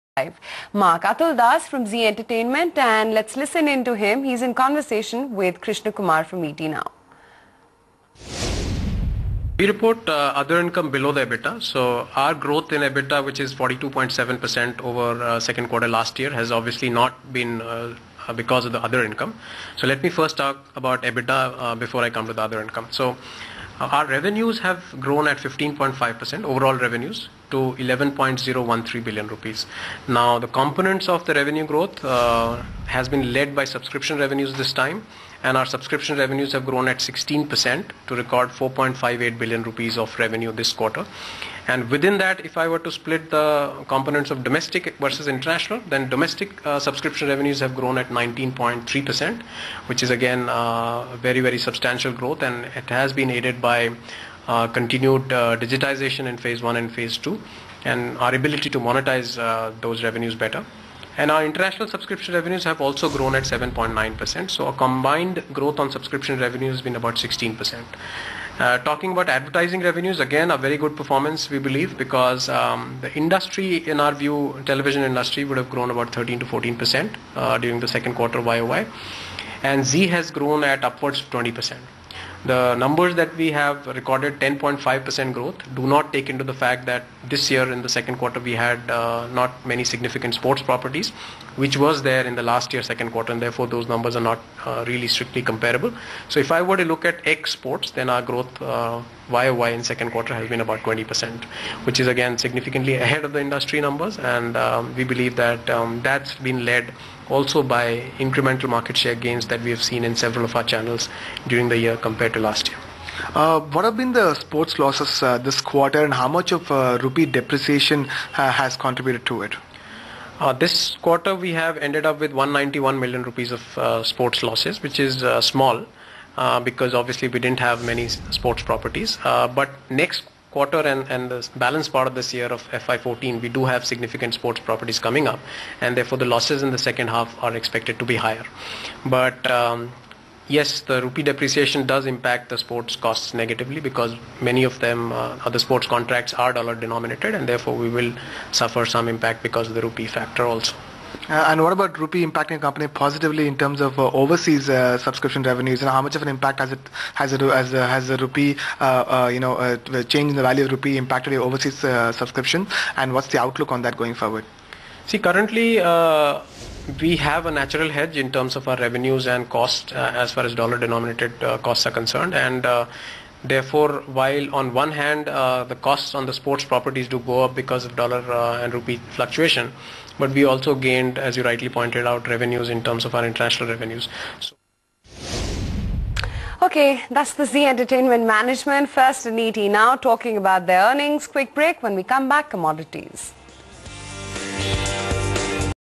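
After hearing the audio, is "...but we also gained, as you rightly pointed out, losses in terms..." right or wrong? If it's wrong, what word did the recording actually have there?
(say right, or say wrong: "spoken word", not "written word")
wrong: "revenues", not "losses".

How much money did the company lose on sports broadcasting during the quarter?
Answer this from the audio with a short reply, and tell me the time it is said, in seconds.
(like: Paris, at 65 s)
191 million rupees, at 122 s.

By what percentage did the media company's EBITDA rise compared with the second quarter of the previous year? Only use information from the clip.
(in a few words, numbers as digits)
42.7%.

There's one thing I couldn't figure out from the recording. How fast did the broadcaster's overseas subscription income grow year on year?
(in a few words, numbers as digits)
7.9%.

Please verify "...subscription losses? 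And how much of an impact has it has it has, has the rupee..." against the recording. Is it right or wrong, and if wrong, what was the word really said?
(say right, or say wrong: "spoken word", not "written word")
wrong: "revenues", not "losses".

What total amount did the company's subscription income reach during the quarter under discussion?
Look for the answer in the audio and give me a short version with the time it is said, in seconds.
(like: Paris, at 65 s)
4.58 billion rupees, at 38 s.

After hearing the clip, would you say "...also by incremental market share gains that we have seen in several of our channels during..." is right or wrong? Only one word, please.
right.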